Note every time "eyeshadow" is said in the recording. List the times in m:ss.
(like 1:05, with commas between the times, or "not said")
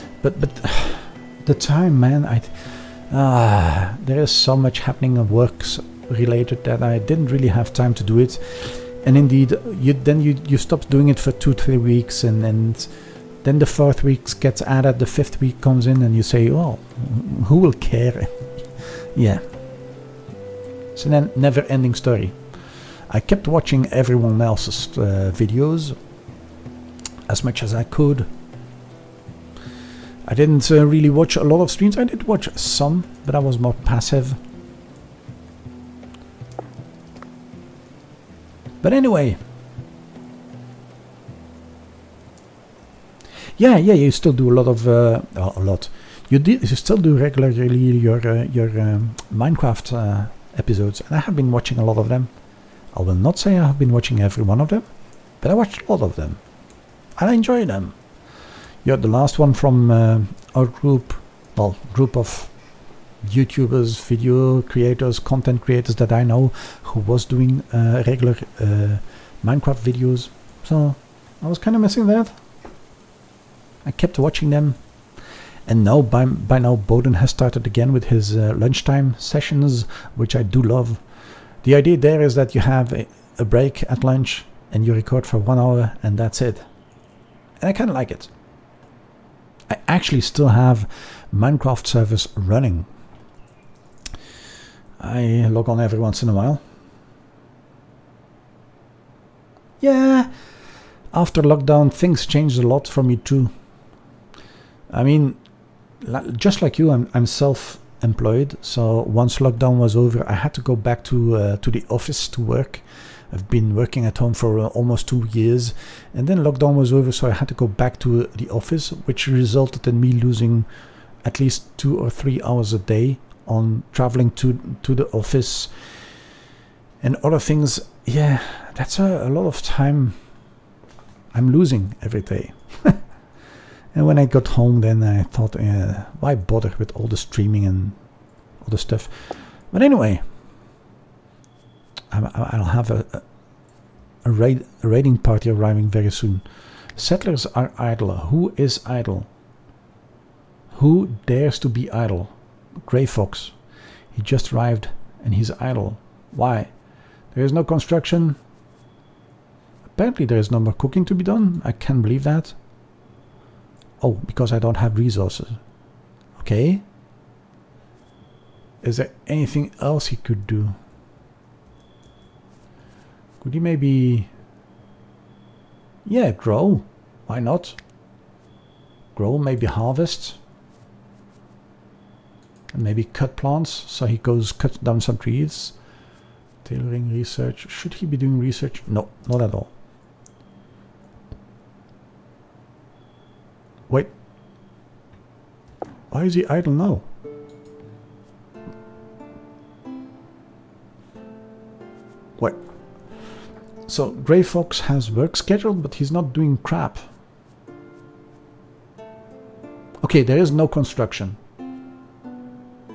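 not said.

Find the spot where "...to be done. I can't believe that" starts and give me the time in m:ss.
2:41.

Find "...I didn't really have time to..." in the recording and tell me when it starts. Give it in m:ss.
0:06.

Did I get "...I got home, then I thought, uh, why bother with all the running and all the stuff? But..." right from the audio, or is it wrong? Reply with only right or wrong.
wrong.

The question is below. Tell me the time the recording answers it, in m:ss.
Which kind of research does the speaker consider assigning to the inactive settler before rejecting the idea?
3:06.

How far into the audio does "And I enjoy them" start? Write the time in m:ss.
0:57.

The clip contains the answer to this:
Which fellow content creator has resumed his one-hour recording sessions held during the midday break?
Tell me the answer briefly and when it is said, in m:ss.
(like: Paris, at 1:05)
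Bowden, at 1:16.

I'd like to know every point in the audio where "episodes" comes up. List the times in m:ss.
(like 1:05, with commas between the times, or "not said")
0:50.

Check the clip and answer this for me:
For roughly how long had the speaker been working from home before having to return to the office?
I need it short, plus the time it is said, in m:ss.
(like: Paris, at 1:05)
almost 2 years, at 1:54.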